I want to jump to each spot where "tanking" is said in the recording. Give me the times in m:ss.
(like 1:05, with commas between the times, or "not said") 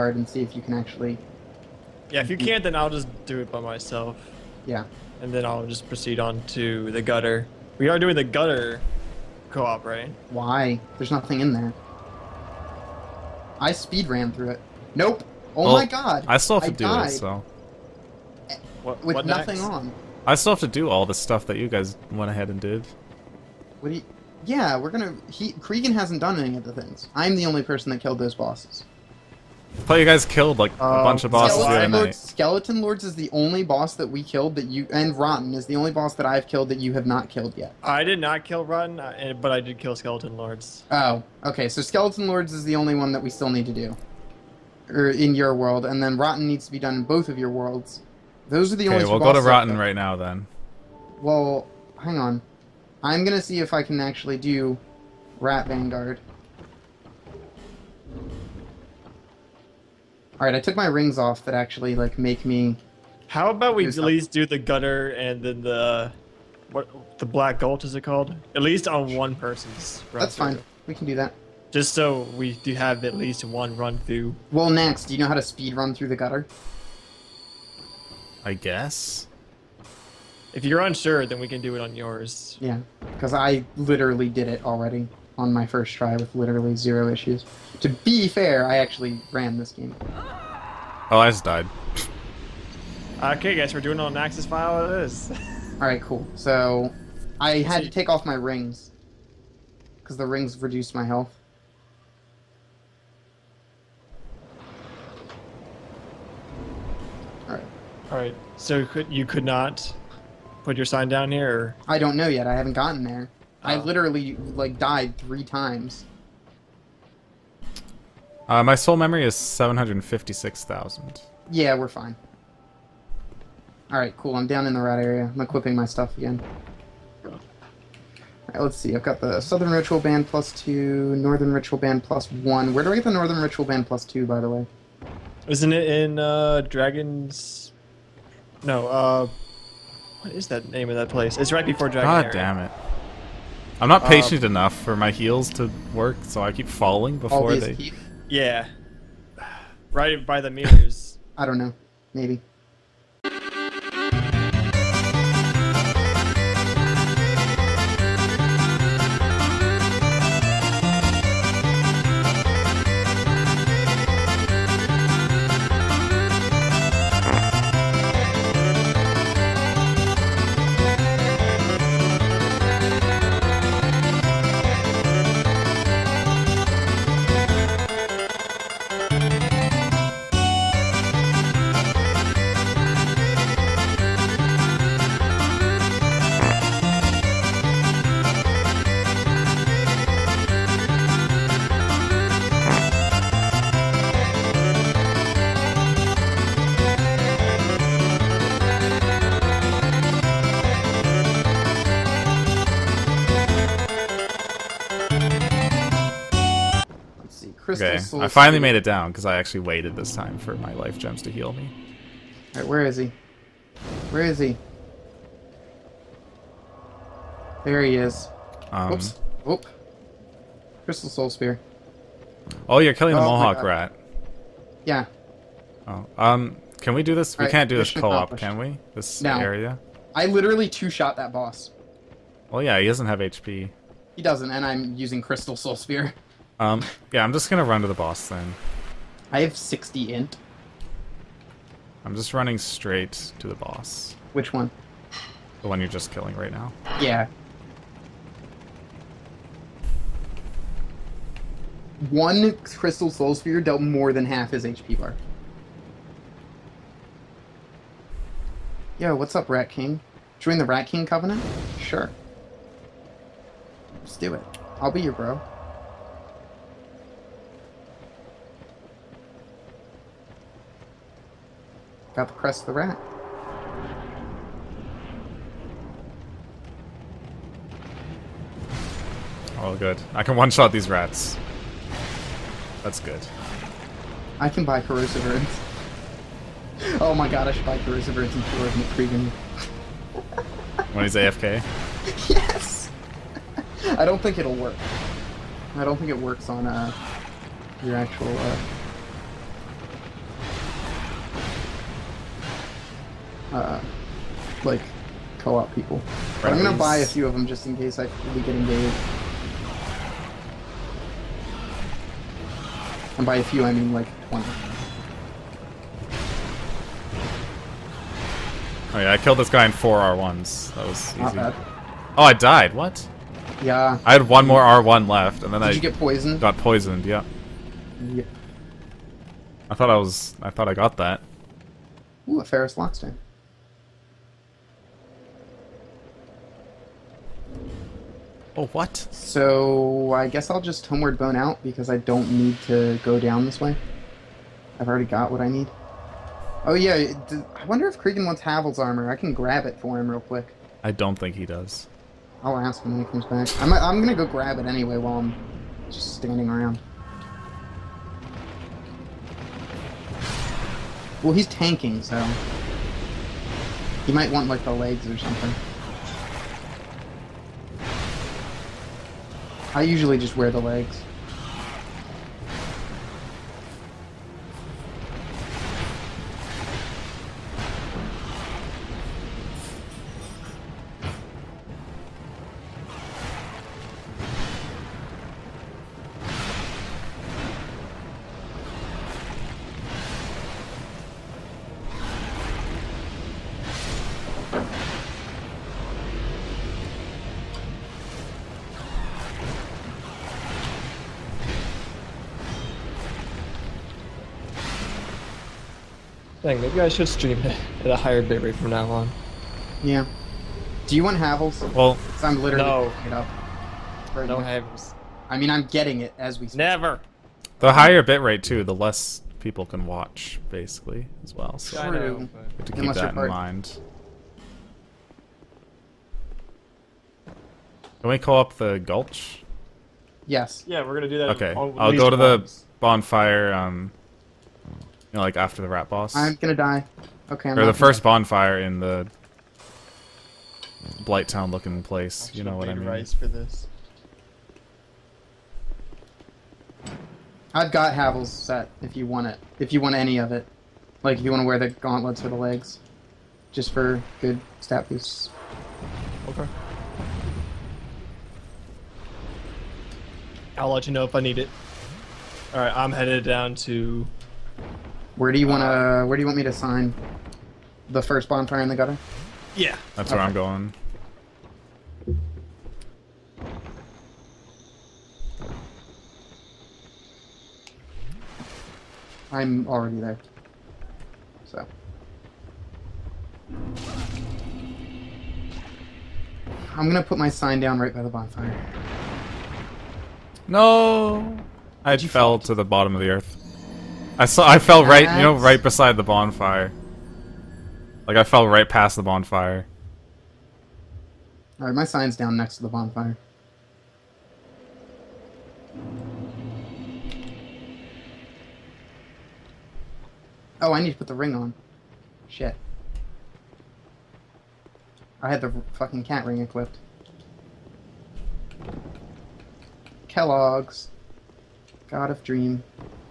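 6:01.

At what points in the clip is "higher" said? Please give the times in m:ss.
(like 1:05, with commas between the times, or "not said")
6:47, 6:57.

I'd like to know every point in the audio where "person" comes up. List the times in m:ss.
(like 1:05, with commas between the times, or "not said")
0:27, 1:09.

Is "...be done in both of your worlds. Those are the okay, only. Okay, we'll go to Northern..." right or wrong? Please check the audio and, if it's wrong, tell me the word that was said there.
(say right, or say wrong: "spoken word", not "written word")
wrong: "Rotten", not "Northern".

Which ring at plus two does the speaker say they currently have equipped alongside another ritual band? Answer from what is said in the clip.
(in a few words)
Southern Ritual Band.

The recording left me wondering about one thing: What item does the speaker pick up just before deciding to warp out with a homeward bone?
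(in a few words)
Pharros Lockstone.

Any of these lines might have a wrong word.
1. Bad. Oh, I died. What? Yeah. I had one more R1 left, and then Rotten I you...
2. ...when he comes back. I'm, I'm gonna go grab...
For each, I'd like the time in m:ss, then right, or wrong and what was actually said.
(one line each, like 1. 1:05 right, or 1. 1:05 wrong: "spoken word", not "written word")
1. 5:21 wrong: "Did", not "Rotten"
2. 5:52 right.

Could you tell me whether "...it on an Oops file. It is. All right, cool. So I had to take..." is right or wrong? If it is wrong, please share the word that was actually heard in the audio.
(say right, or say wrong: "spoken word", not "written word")
wrong: "Axis", not "Oops".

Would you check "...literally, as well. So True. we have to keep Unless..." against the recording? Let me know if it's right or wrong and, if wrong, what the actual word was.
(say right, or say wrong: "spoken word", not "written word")
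wrong: "basically", not "literally".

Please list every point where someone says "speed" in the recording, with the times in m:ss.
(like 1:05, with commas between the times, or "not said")
0:13, 1:15.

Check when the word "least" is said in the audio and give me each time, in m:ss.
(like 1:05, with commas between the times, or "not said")
1:03, 1:08, 1:13.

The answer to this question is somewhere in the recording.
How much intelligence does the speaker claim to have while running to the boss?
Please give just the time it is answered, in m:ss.
3:59.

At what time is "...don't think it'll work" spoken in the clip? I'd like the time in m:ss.
4:54.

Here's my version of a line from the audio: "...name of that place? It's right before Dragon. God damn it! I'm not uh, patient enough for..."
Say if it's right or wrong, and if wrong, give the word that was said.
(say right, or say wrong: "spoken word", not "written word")
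right.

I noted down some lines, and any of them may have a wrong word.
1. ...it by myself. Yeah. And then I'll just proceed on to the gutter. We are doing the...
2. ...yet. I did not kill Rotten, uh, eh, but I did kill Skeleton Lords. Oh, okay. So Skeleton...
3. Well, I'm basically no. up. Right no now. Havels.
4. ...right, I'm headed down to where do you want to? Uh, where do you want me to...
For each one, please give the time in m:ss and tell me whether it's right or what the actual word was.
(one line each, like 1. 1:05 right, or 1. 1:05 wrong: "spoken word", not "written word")
1. 0:03 right
2. 0:37 right
3. 6:51 wrong: "literally", not "basically"
4. 7:42 right.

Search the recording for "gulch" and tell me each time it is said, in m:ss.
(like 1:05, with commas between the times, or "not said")
1:07, 7:08.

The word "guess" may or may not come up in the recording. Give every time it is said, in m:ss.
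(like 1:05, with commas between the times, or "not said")
1:18, 5:40.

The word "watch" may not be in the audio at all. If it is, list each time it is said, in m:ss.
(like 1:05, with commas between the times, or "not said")
6:59.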